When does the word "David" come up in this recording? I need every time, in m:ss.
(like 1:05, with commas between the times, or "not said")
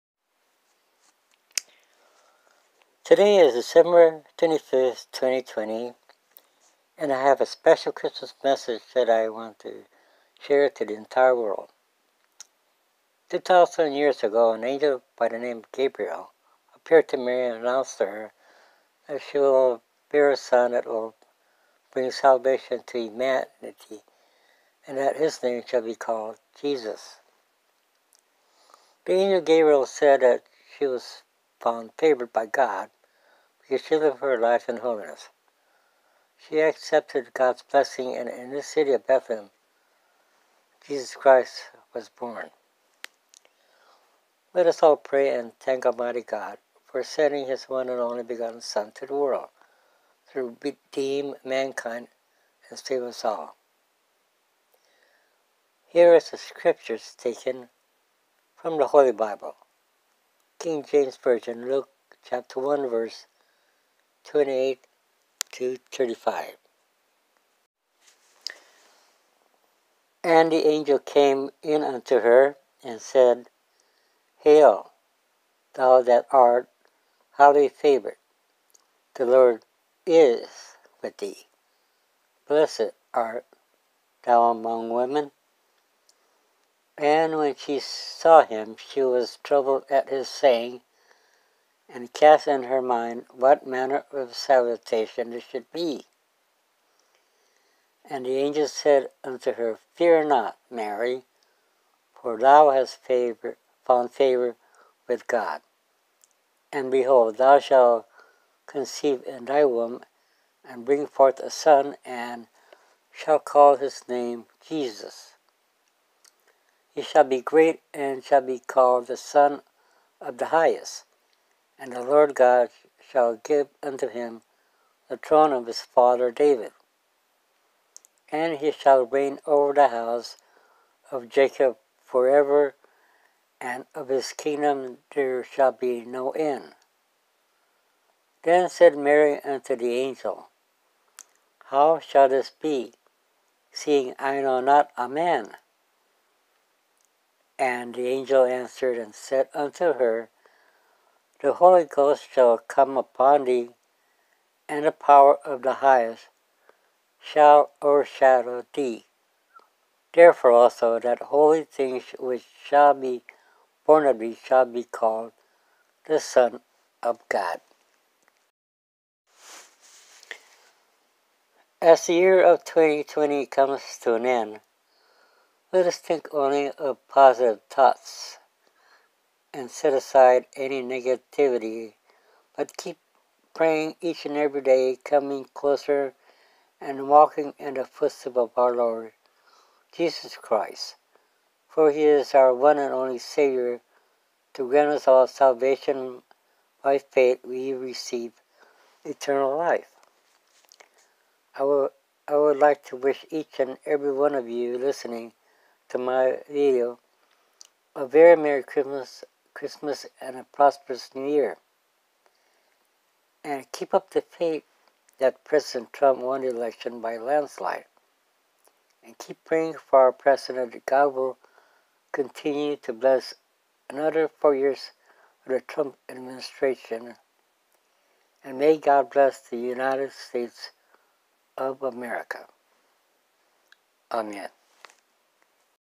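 2:06.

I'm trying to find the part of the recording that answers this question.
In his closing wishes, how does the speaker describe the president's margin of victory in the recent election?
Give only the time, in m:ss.
3:36.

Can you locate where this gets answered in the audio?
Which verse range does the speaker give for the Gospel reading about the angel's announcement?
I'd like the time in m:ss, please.
1:04.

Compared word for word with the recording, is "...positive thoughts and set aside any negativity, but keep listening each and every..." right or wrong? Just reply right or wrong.
wrong.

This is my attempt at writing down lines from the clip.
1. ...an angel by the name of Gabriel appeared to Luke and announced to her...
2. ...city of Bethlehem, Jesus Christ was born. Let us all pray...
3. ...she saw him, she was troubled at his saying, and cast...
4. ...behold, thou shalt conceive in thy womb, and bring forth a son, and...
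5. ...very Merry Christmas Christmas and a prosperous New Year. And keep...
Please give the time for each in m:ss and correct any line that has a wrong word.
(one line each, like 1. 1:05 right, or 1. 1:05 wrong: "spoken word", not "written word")
1. 0:14 wrong: "Mary", not "Luke"
2. 0:38 right
3. 1:27 right
4. 1:46 right
5. 3:28 right.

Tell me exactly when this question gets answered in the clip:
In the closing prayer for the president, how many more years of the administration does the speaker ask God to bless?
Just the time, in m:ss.
3:44.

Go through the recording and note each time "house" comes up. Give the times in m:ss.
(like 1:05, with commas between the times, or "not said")
2:09.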